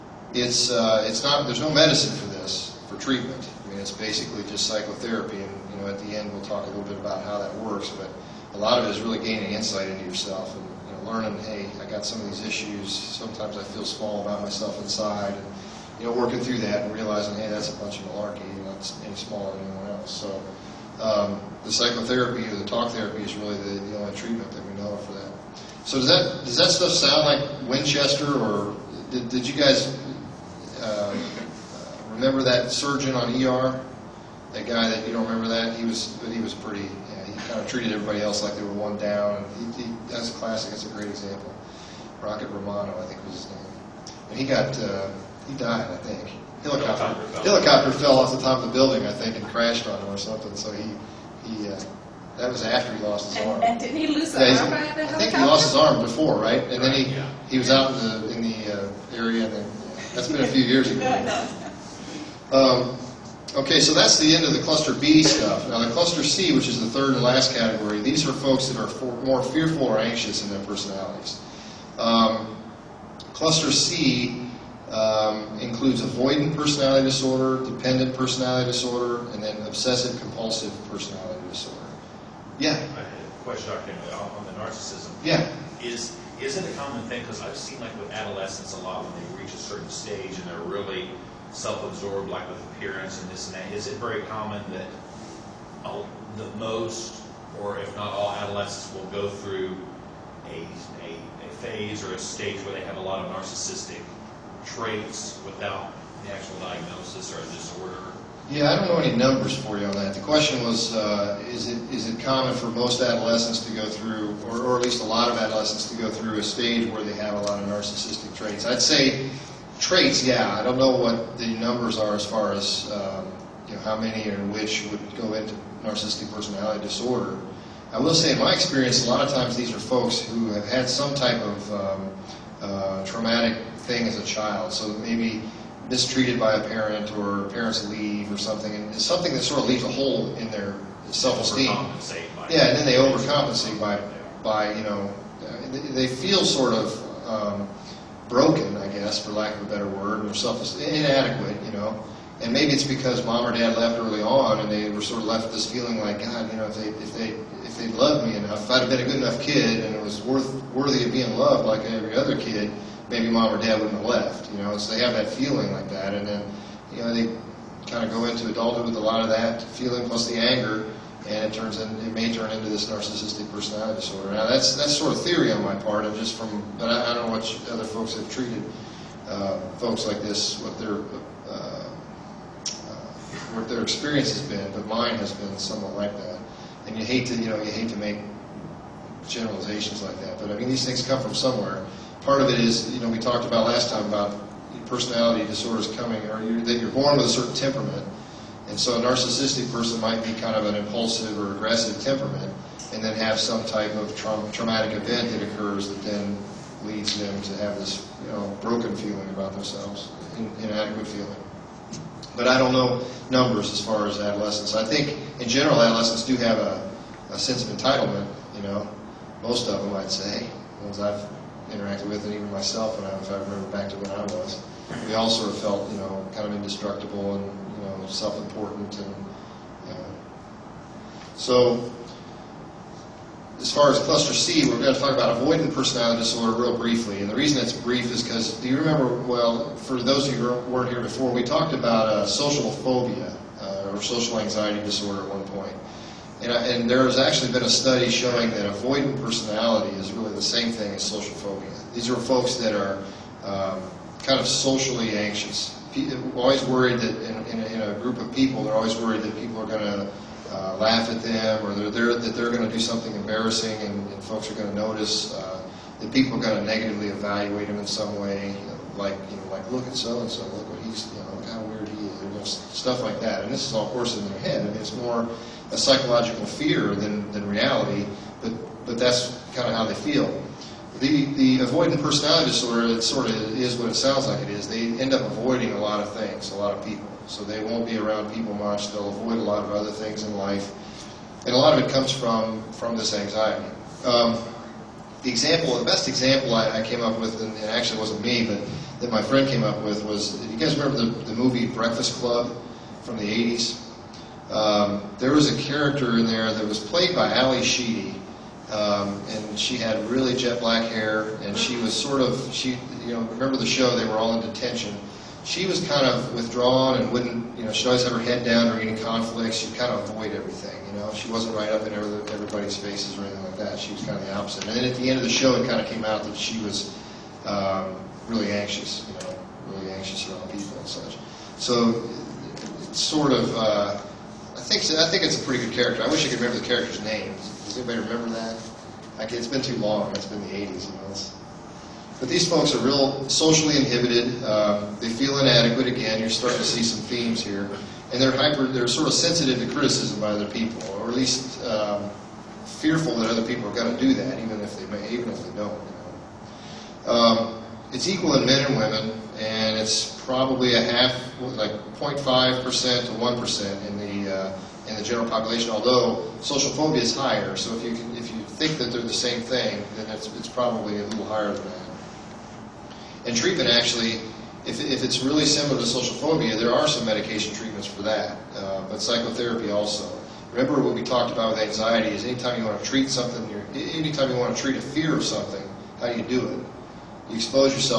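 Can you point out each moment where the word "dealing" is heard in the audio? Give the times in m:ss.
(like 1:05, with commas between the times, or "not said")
not said.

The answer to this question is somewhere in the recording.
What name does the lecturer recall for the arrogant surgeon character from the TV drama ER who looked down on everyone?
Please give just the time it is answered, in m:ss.
0:42.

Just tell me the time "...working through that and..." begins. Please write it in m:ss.
0:16.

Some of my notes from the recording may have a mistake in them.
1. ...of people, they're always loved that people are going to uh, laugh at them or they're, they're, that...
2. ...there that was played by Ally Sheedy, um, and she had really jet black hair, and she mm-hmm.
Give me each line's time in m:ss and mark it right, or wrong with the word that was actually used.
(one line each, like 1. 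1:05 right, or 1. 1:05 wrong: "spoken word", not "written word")
1. 4:18 wrong: "worried", not "loved"
2. 5:06 right.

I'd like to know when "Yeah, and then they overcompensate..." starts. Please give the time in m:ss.
2:22.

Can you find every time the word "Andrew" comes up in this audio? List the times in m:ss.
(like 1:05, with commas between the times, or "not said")
not said.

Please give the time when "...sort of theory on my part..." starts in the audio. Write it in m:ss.
2:54.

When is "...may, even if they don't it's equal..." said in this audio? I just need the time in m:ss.
5:54.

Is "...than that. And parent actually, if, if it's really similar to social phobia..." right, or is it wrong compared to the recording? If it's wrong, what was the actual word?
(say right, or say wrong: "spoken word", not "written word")
wrong: "treatment", not "parent".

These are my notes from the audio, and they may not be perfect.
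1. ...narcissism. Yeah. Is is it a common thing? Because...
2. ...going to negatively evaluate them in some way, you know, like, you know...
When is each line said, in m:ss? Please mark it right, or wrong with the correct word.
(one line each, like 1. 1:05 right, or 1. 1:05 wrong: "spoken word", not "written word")
1. 1:24 right
2. 4:26 right.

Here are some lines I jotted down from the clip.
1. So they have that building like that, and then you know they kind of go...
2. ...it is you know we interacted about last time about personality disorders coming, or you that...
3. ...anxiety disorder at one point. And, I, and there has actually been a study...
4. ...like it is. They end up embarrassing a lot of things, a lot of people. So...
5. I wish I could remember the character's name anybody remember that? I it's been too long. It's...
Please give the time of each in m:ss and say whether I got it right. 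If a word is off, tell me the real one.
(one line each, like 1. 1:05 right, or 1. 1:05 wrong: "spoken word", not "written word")
1. 2:44 wrong: "feeling", not "building"
2. 3:12 wrong: "talked", not "interacted"
3. 4:04 right
4. 4:44 wrong: "avoiding", not "embarrassing"
5. 5:36 right.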